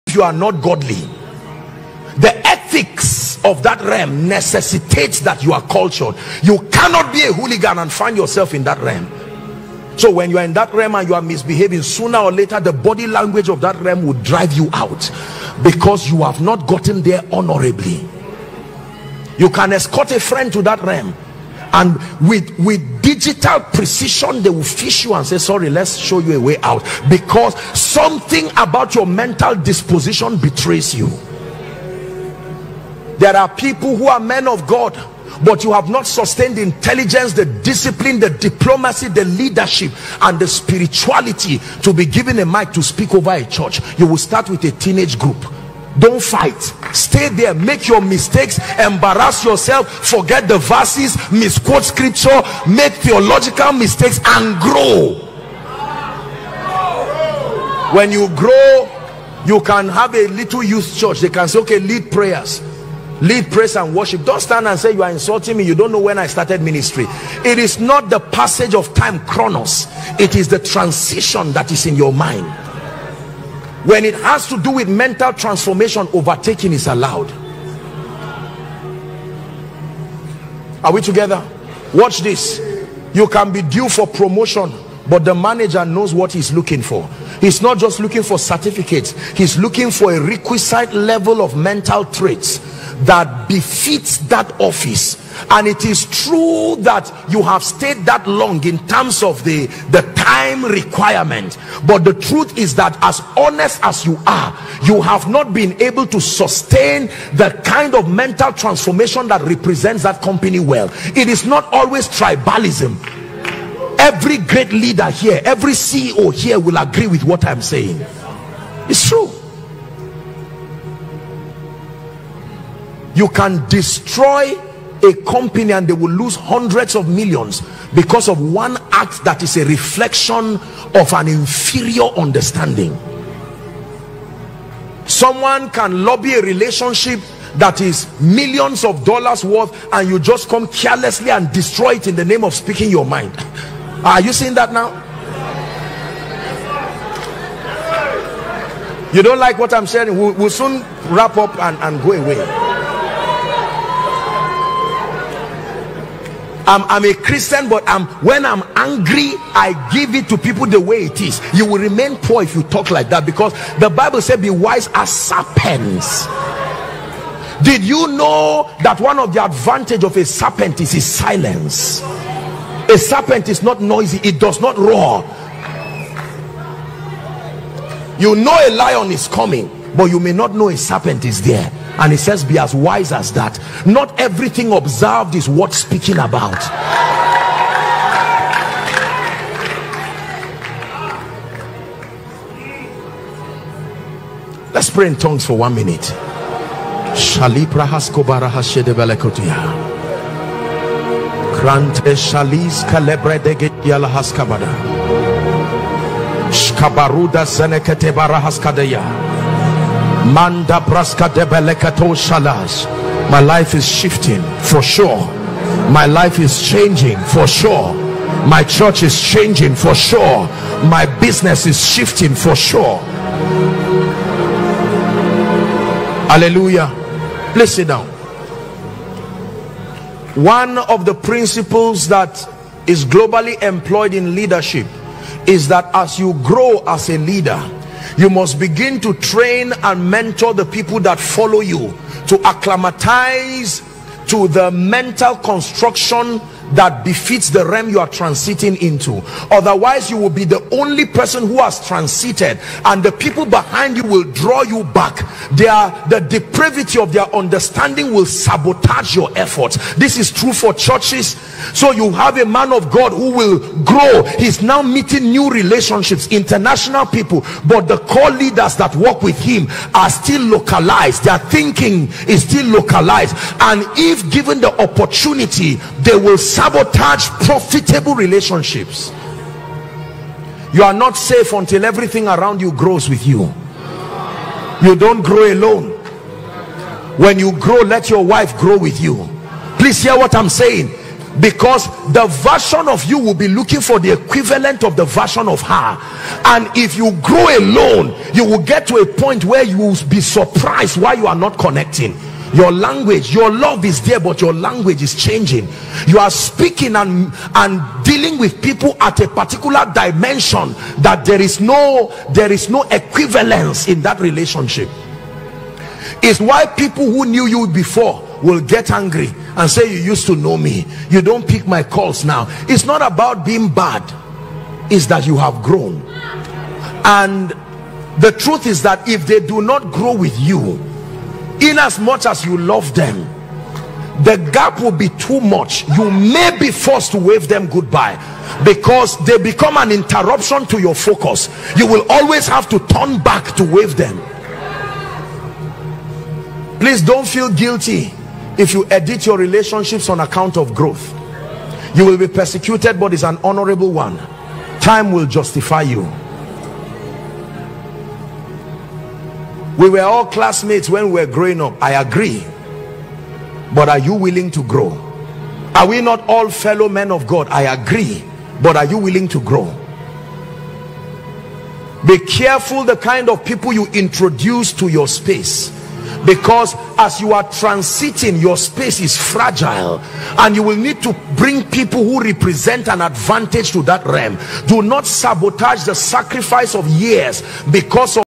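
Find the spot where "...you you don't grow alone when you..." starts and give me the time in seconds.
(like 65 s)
283 s.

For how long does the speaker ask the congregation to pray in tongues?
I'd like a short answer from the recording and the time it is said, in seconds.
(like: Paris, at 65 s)
one minute, at 195 s.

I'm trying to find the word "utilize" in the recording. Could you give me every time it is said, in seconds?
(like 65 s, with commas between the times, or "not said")
not said.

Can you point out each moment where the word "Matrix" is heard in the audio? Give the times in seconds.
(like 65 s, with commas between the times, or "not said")
not said.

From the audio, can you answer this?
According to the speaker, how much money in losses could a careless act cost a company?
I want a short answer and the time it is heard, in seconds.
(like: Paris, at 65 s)
hundreds of millions, at 126 s.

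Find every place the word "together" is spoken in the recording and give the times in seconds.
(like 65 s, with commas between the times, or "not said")
81 s.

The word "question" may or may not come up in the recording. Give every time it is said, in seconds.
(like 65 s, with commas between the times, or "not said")
not said.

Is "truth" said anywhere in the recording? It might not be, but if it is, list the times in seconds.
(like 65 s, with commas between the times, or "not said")
102 s, 328 s.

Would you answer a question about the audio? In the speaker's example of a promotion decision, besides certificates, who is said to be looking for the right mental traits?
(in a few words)
the manager.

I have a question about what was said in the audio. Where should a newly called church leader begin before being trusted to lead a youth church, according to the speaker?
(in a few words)
a teenage group.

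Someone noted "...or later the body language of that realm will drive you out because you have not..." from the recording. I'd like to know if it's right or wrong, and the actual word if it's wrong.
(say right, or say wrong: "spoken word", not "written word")
right.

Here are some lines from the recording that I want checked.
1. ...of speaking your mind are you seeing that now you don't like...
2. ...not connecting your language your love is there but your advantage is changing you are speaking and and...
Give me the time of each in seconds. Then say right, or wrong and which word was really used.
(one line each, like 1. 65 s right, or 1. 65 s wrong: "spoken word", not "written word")
1. 142 s right
2. 301 s wrong: "language", not "advantage".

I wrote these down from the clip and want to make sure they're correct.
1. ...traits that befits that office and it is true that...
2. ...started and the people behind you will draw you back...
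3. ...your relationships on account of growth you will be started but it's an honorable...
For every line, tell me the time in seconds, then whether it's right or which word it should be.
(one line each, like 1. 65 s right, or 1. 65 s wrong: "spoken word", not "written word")
1. 92 s right
2. 251 s wrong: "transited", not "started"
3. 349 s wrong: "persecuted", not "started".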